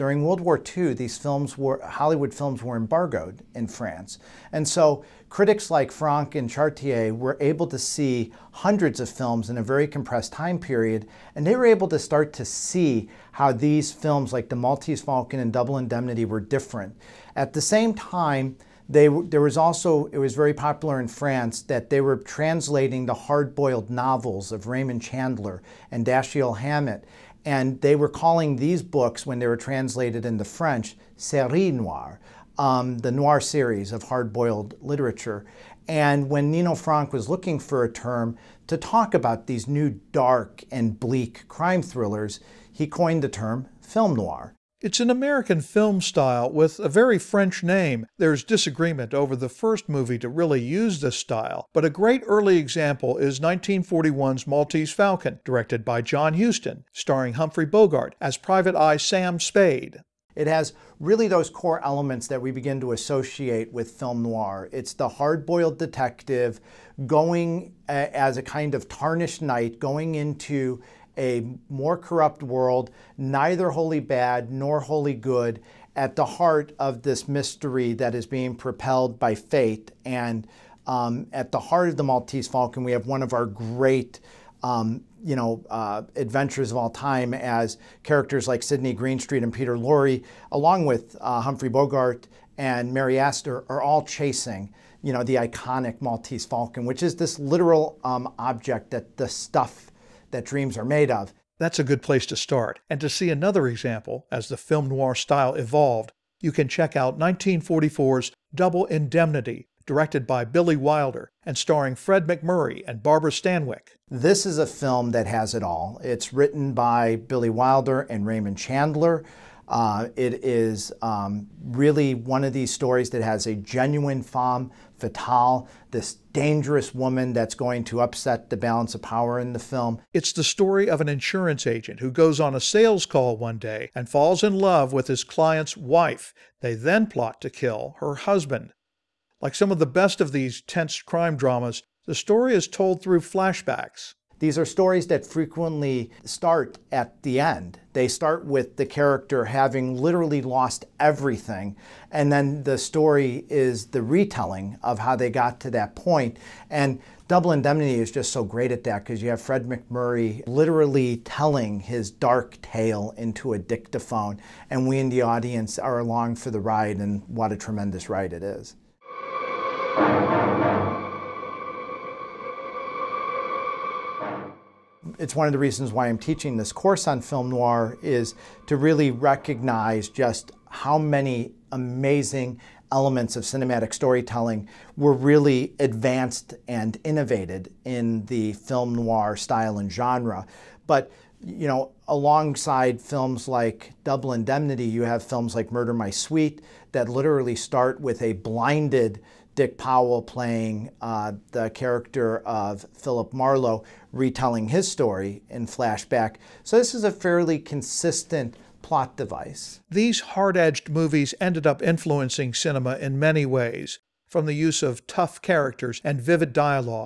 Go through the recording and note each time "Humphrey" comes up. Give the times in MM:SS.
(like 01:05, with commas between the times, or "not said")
00:57, 01:31.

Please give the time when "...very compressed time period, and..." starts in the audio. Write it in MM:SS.
00:09.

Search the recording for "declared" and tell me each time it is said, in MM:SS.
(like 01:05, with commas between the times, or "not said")
not said.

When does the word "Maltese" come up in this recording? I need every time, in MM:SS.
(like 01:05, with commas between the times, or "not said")
00:14, 00:54, 01:22, 01:36.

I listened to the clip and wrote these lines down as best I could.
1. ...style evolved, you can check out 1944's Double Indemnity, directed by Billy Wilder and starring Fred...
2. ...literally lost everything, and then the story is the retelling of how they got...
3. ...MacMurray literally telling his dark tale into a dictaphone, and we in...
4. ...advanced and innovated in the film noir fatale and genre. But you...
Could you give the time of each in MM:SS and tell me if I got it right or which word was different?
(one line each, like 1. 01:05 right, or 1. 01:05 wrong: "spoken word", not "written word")
1. 01:45 right
2. 02:29 right
3. 02:39 right
4. 03:05 wrong: "style", not "fatale".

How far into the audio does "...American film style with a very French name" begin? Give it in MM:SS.
00:45.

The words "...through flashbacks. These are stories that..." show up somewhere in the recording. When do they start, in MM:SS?
02:23.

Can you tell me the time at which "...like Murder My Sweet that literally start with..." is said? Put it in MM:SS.
03:15.